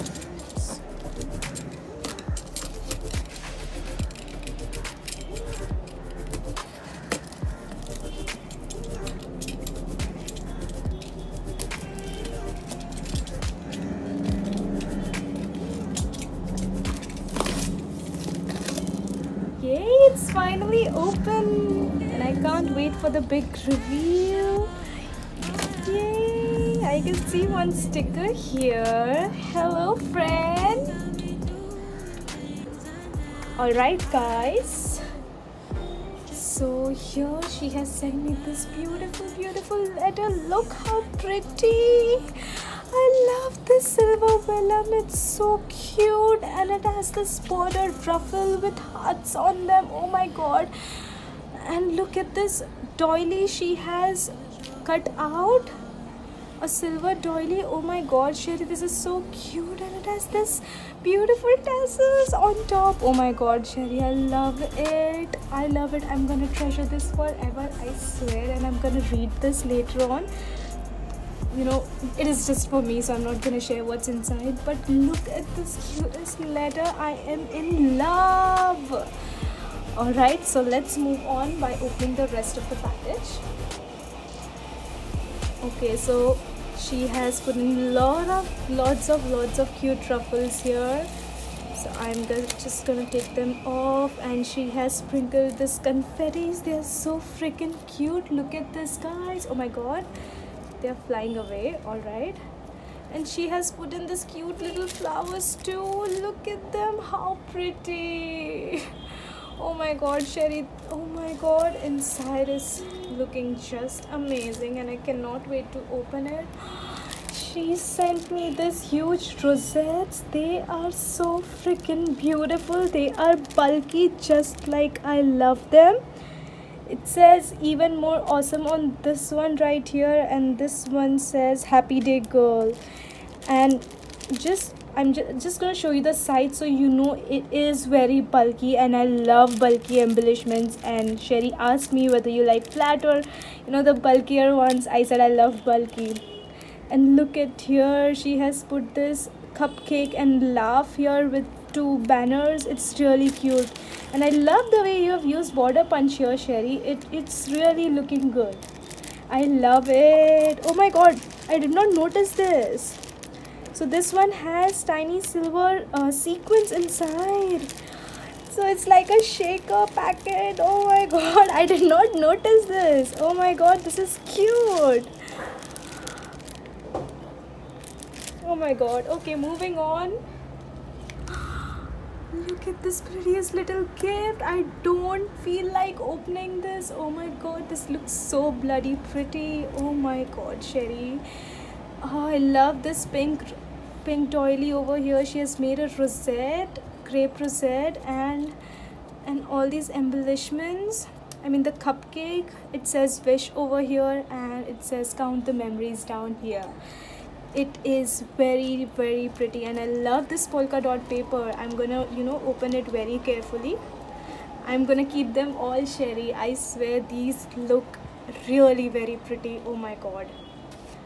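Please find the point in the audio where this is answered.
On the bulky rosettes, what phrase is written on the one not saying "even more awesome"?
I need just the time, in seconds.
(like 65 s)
131 s.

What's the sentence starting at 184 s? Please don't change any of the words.
I don't feel like opening this.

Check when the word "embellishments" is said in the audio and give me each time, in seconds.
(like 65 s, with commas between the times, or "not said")
139 s, 199 s.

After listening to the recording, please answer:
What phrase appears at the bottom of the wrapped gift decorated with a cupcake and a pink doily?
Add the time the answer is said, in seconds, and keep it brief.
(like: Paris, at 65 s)
Count the memories, at 205 s.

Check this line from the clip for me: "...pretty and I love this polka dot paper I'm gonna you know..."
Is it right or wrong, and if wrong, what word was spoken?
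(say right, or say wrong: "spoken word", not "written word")
right.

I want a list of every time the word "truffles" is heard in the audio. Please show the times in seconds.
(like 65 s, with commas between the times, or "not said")
90 s.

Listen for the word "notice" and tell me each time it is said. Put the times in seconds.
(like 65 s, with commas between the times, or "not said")
161 s, 172 s.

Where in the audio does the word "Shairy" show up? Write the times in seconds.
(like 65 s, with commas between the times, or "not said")
58 s, 63 s, 110 s, 141 s, 156 s, 190 s, 215 s.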